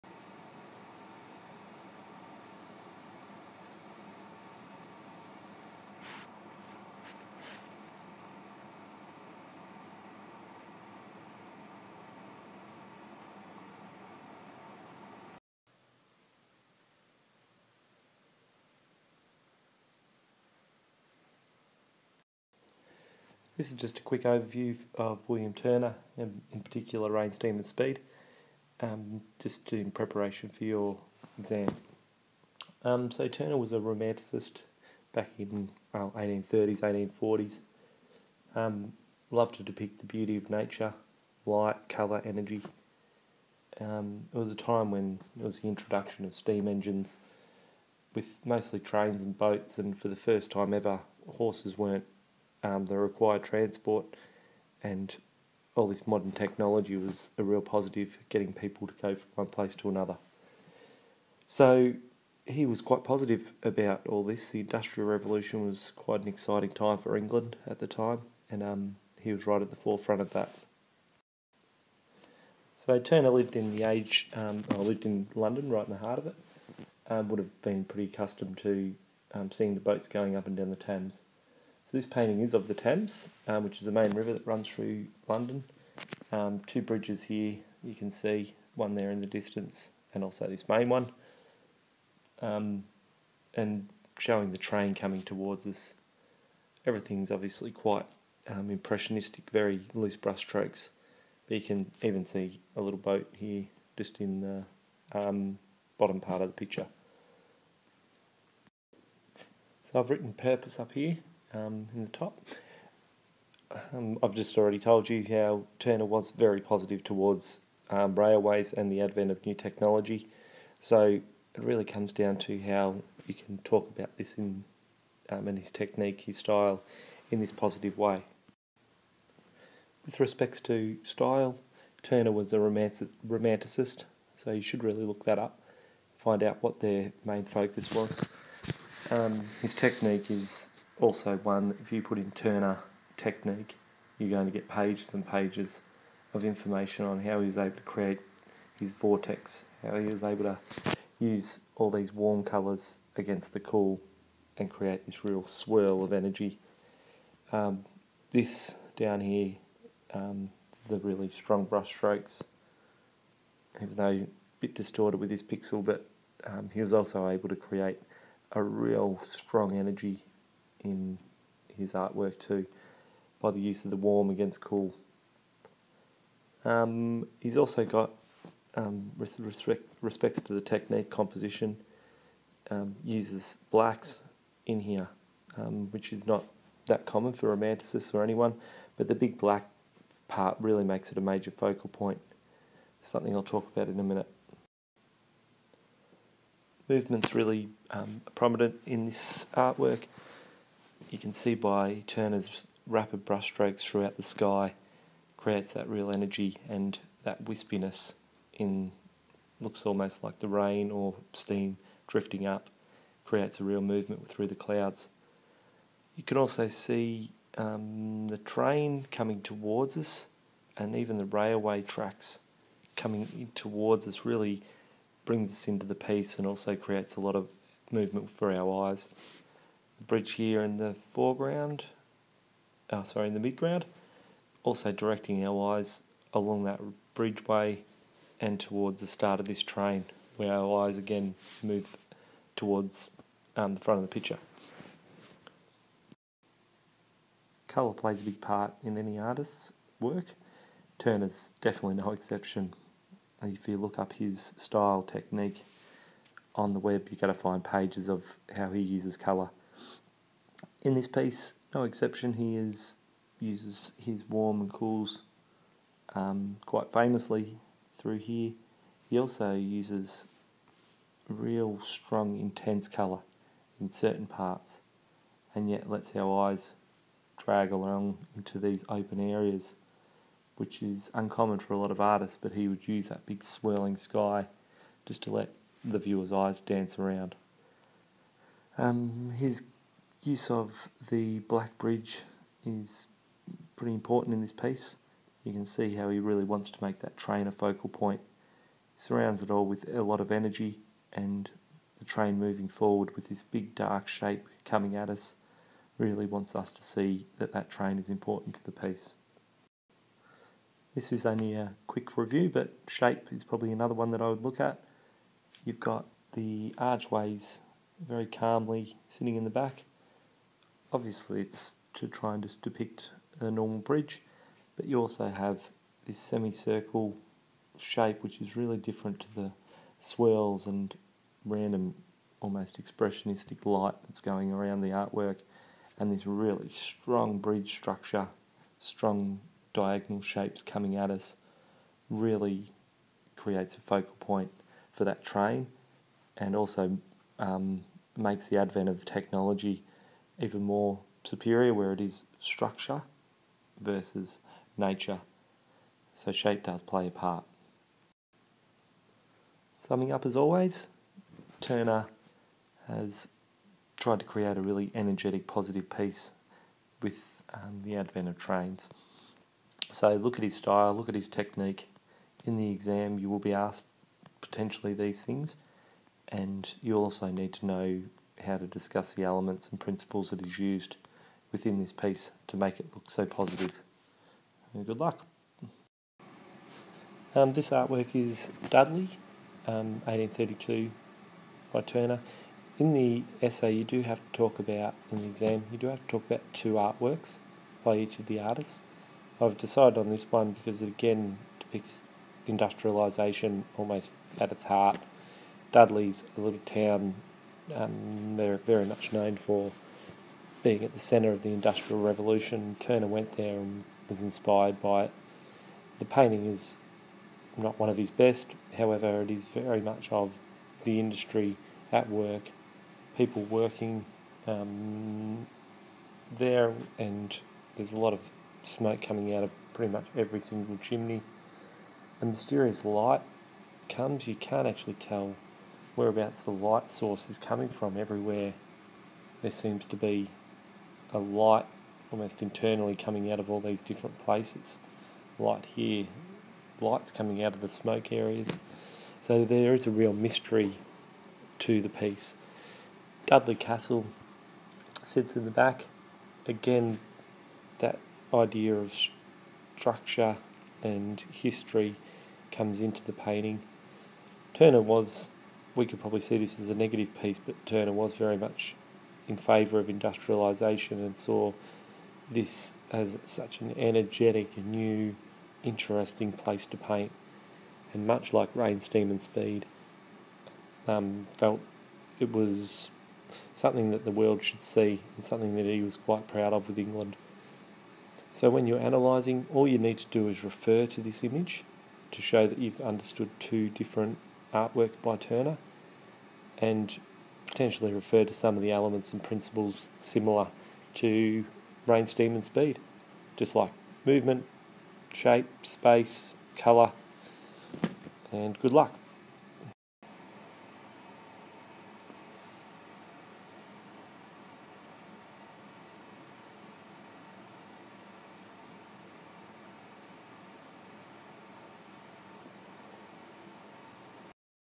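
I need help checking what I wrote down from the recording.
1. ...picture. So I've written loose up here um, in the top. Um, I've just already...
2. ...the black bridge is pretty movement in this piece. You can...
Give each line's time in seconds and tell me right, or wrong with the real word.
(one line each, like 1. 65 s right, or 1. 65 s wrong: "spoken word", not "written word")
1. 106 s wrong: "purpose", not "loose"
2. 291 s wrong: "important", not "movement".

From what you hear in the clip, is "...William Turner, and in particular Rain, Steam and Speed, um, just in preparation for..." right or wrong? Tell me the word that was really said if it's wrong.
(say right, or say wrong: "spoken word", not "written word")
right.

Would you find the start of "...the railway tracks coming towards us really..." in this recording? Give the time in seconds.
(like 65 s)
221 s.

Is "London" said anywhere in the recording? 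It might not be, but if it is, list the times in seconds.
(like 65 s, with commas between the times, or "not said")
75 s, 85 s.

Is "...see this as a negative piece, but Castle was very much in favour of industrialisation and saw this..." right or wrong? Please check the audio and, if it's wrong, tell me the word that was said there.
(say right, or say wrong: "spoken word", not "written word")
wrong: "Turner", not "Castle".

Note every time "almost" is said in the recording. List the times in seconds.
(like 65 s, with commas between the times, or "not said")
209 s, 332 s, 403 s, 442 s.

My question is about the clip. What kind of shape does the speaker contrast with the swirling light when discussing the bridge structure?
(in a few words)
Semicircle.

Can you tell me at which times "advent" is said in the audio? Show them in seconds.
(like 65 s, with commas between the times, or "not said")
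119 s, 348 s, 367 s.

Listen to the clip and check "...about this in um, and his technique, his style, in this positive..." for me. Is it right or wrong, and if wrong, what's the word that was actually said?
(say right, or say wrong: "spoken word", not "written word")
right.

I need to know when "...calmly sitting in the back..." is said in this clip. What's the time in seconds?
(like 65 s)
318 s.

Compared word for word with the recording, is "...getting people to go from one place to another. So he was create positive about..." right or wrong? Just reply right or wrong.
wrong.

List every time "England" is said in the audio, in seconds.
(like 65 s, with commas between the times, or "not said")
67 s, 486 s.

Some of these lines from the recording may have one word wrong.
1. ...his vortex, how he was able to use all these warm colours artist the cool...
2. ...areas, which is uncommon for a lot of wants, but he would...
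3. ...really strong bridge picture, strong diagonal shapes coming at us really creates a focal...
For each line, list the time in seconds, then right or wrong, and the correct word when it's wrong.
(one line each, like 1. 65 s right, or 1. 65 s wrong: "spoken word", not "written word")
1. 148 s wrong: "against", not "artist"
2. 279 s wrong: "artists", not "wants"
3. 336 s wrong: "structure", not "picture".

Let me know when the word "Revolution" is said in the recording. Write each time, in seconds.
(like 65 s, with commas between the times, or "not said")
65 s, 412 s.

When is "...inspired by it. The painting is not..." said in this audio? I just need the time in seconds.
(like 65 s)
414 s.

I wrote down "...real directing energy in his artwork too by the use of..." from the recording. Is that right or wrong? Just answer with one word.
wrong.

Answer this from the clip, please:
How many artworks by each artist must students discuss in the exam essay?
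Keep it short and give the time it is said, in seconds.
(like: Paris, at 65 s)
2, at 396 s.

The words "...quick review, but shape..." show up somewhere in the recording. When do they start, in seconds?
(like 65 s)
311 s.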